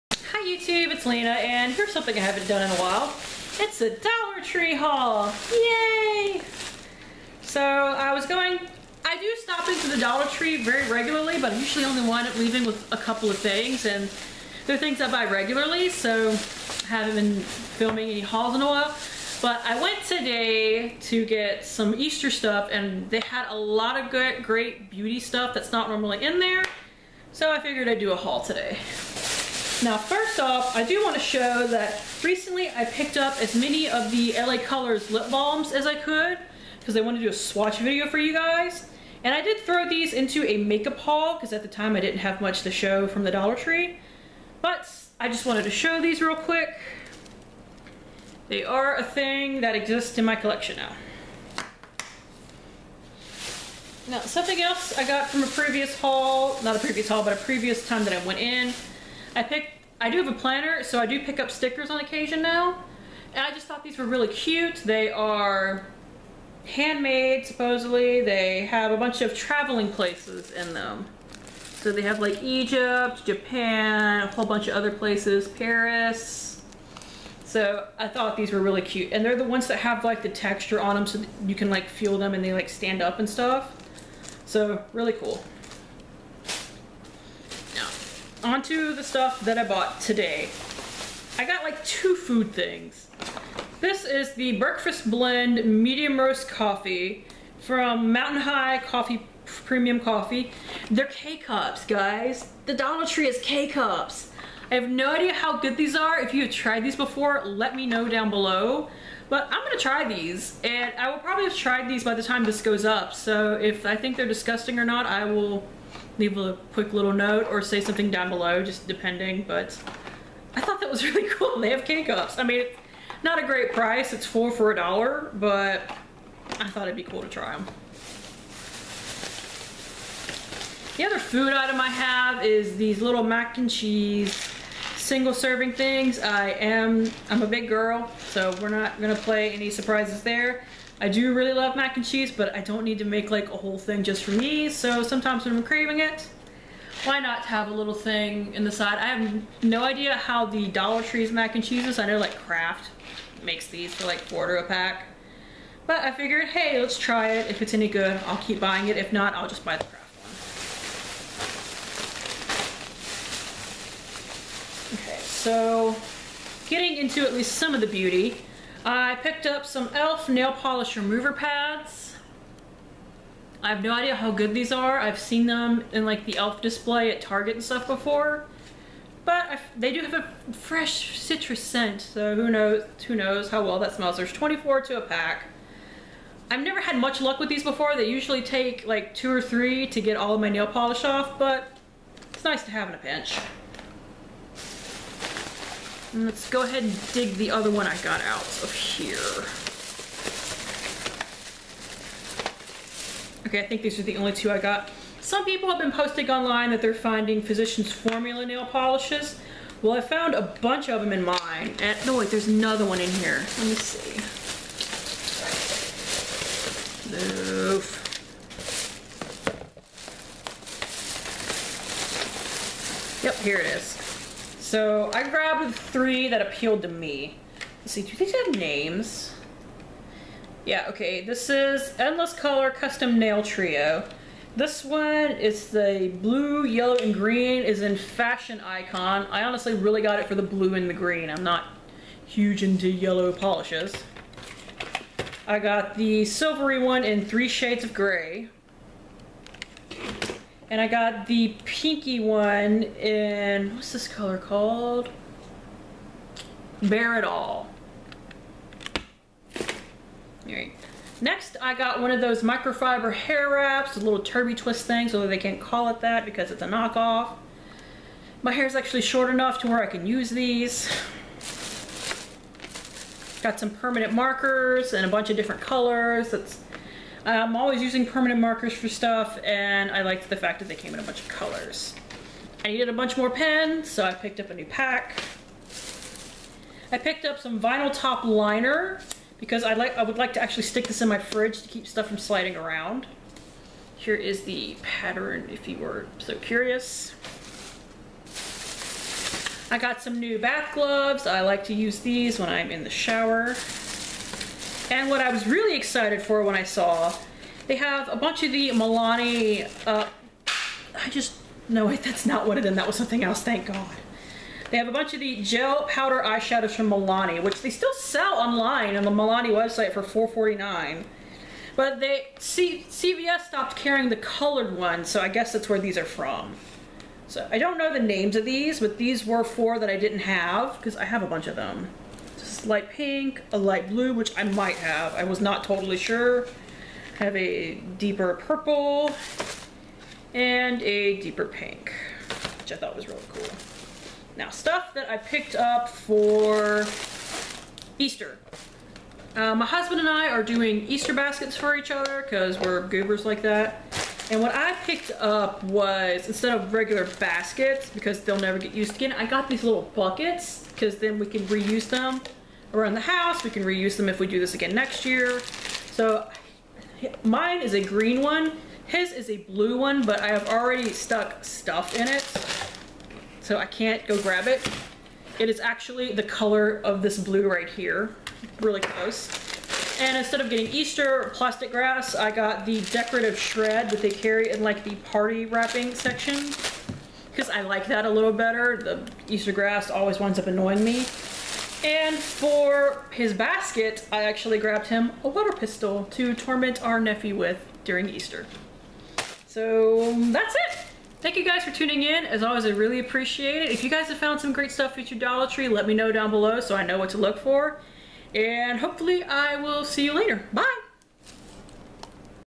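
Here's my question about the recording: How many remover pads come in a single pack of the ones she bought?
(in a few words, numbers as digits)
24.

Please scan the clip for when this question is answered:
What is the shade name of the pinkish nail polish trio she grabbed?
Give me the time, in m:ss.
4:16.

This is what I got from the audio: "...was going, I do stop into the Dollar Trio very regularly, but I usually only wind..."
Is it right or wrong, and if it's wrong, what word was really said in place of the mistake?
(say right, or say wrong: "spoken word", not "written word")
wrong: "Tree", not "Trio".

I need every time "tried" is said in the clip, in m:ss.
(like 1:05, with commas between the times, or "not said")
1:46, 1:51.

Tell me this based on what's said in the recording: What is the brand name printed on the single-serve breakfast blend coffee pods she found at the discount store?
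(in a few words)
Mountain High Coffee.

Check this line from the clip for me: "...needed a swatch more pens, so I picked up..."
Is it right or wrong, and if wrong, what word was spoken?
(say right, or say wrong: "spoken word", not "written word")
wrong: "bunch", not "swatch".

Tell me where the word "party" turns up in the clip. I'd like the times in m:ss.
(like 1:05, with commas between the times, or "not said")
6:25.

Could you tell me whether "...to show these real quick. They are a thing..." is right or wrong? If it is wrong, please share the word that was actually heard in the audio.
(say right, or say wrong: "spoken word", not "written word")
right.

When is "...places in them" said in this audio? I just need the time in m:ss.
1:09.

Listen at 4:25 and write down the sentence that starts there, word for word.
although they can't call it that because it's a knockoff.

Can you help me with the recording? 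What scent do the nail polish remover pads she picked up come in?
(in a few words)
fresh citrus.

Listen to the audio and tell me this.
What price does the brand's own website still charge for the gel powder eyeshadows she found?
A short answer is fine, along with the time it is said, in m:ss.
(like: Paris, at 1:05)
$4.49, at 5:20.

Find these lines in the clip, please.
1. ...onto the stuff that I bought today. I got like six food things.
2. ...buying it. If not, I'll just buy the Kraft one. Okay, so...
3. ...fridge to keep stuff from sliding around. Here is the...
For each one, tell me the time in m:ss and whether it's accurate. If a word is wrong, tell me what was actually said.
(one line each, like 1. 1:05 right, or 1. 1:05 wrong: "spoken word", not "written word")
1. 1:28 wrong: "two", not "six"
2. 2:38 right
3. 4:51 right.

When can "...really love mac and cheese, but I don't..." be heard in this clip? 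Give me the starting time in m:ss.
2:21.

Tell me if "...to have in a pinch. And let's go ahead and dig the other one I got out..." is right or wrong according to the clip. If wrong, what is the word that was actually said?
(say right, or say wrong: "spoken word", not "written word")
right.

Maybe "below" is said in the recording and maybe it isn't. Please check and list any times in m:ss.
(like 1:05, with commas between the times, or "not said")
1:48, 1:58, 6:46.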